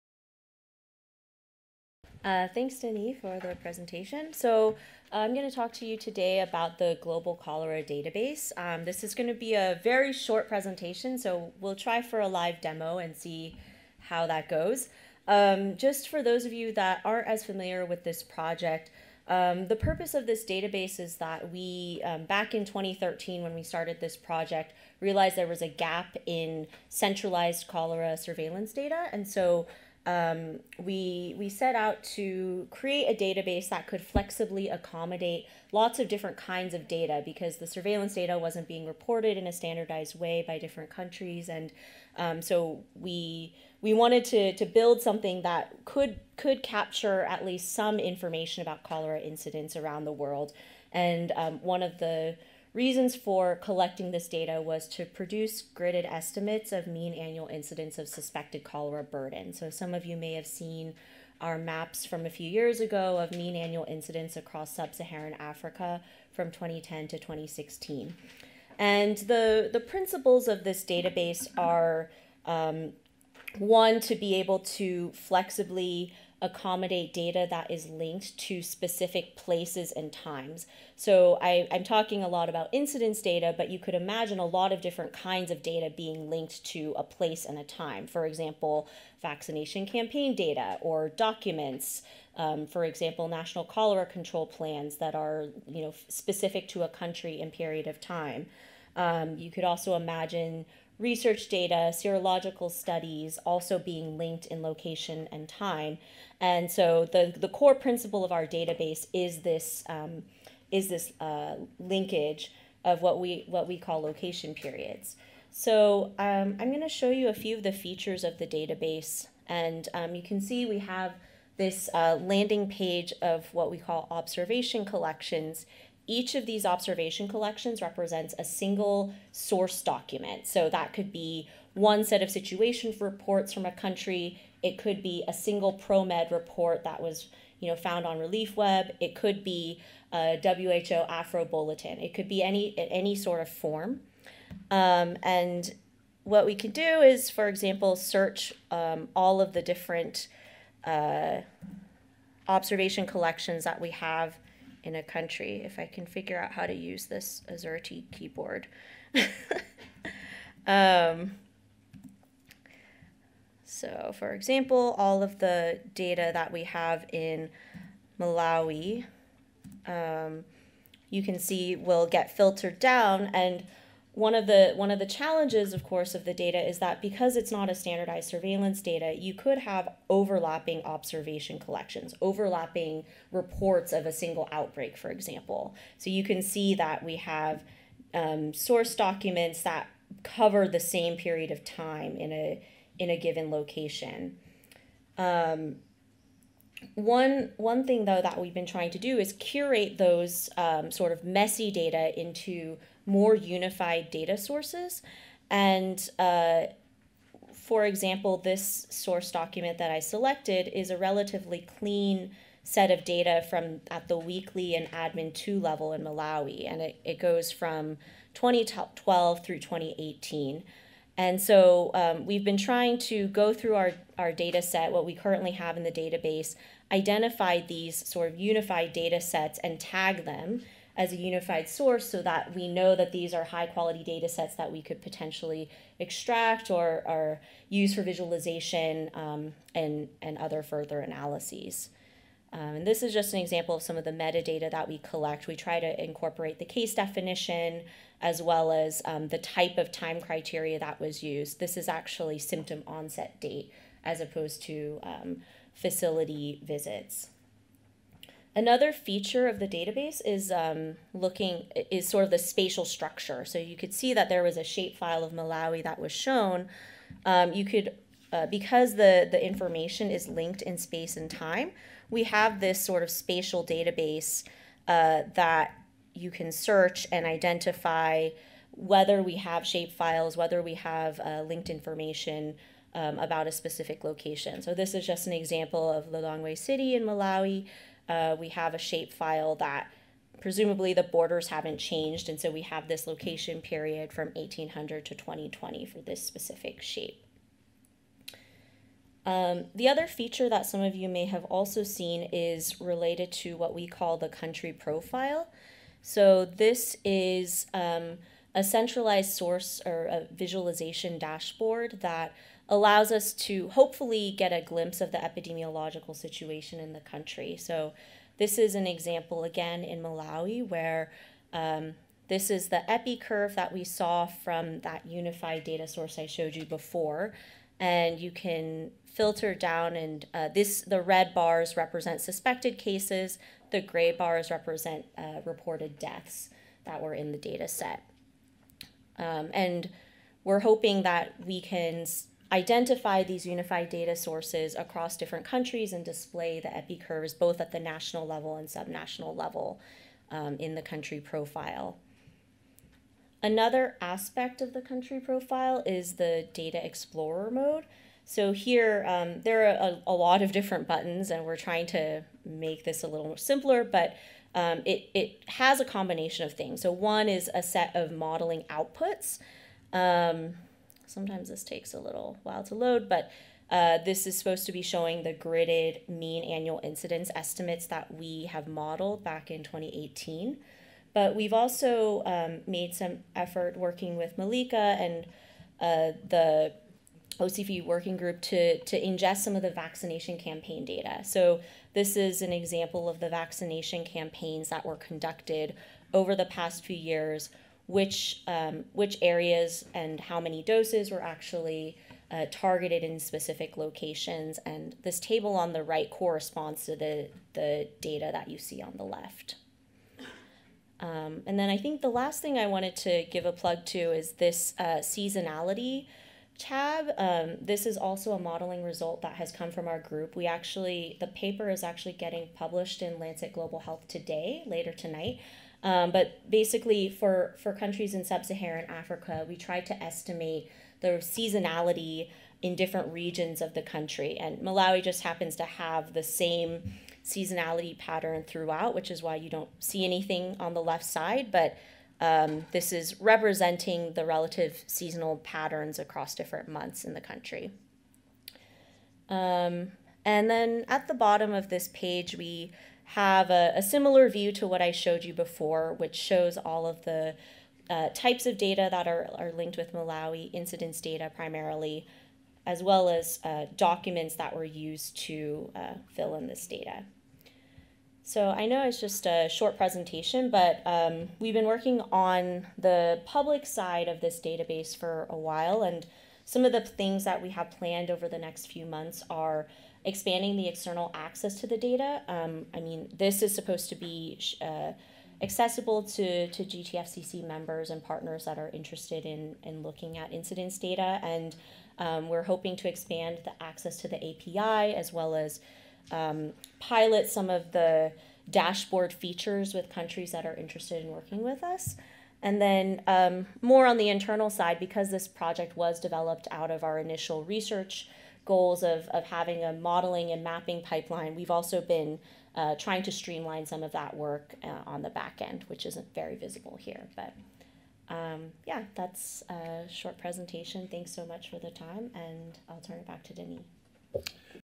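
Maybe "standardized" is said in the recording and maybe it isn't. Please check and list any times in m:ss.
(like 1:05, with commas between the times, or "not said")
0:39, 2:57.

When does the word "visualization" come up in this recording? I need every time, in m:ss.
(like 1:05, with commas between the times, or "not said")
3:58, 5:10.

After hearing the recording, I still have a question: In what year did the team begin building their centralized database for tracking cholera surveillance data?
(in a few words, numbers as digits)
2013.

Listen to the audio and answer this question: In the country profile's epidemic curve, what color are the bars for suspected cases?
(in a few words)
red.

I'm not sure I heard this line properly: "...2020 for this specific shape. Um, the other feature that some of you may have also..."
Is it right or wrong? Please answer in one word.
right.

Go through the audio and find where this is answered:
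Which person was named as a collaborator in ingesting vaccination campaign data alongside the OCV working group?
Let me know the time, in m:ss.
6:24.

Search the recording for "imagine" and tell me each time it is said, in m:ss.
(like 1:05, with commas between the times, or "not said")
1:23, 1:39.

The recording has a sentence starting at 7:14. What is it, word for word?
And Malawi just happens to have the same seasonality pattern throughout, which is why you don't see anything on the left side.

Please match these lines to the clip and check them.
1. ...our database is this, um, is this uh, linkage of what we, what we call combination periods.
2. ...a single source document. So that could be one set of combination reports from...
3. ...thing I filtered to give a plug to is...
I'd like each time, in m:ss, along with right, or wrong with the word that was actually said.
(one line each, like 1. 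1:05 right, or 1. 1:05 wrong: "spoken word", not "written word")
1. 1:48 wrong: "location", not "combination"
2. 2:08 wrong: "situation", not "combination"
3. 6:52 wrong: "wanted", not "filtered".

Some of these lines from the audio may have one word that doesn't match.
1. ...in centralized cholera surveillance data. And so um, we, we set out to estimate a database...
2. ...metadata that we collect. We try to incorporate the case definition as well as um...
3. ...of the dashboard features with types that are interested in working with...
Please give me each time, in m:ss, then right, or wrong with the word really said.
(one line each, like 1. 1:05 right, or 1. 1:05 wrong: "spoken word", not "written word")
1. 0:26 wrong: "create", not "estimate"
2. 4:04 right
3. 8:17 wrong: "countries", not "types".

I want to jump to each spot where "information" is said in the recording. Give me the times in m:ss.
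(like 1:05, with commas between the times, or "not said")
0:47, 4:29, 4:41.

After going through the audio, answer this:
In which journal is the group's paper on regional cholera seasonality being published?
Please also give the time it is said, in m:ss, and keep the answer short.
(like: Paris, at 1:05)
Lancet Global Health, at 7:03.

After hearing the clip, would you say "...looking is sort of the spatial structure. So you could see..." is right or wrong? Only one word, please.
right.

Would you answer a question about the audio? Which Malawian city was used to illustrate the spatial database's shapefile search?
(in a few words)
Lilongwe City.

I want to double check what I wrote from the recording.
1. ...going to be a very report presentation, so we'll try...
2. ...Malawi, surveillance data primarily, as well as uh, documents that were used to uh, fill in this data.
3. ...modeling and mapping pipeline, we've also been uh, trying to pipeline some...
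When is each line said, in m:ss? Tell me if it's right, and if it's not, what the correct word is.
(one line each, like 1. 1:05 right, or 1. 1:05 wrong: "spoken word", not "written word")
1. 0:09 wrong: "short", not "report"
2. 7:39 wrong: "incidence", not "surveillance"
3. 8:29 wrong: "streamline", not "pipeline".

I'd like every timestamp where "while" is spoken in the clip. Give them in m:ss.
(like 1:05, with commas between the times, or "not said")
6:12, 7:55.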